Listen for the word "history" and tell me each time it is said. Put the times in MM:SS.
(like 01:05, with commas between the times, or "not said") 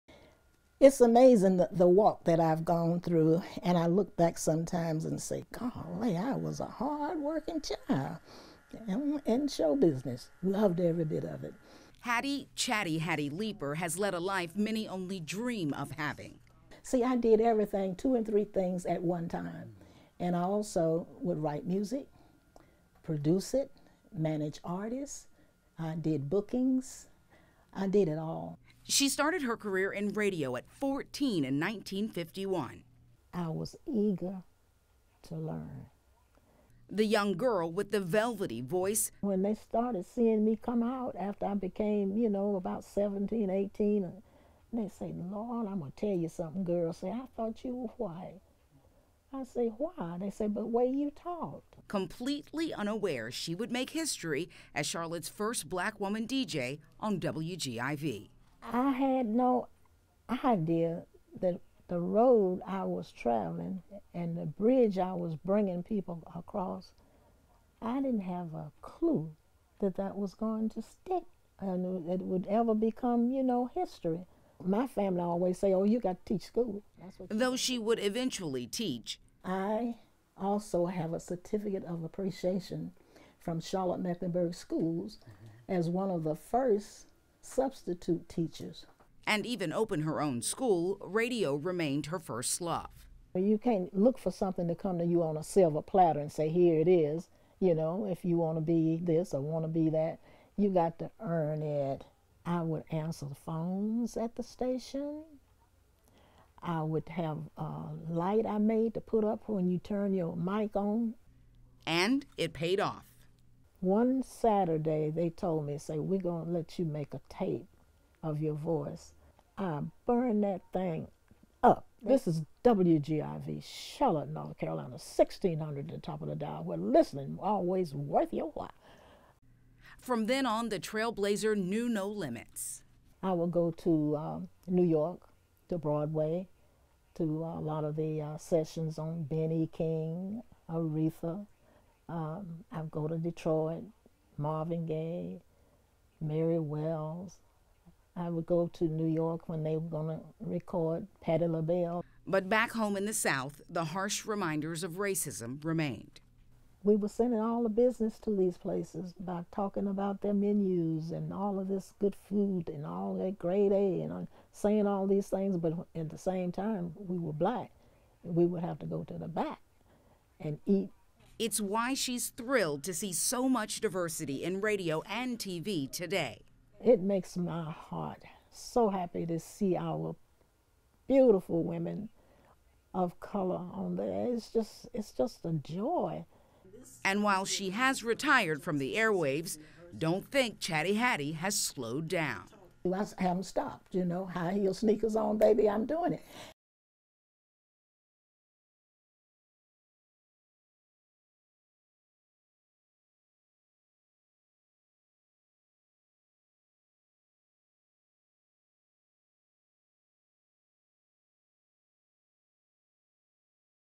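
00:53, 01:13.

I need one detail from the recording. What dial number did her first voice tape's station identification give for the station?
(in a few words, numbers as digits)
1600.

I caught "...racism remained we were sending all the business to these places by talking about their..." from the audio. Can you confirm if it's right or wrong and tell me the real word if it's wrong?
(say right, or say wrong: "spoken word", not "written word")
right.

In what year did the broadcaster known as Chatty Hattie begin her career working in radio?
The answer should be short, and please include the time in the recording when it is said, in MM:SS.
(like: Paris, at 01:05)
1951, at 00:31.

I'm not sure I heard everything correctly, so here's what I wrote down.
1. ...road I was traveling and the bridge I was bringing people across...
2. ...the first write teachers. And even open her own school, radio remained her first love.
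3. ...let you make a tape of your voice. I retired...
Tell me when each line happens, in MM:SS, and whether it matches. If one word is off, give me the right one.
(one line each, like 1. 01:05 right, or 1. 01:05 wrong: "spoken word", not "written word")
1. 01:01 right
2. 01:26 wrong: "substitute", not "write"
3. 01:56 wrong: "burned", not "retired".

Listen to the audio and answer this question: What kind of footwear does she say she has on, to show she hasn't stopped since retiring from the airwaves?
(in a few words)
high heel sneakers.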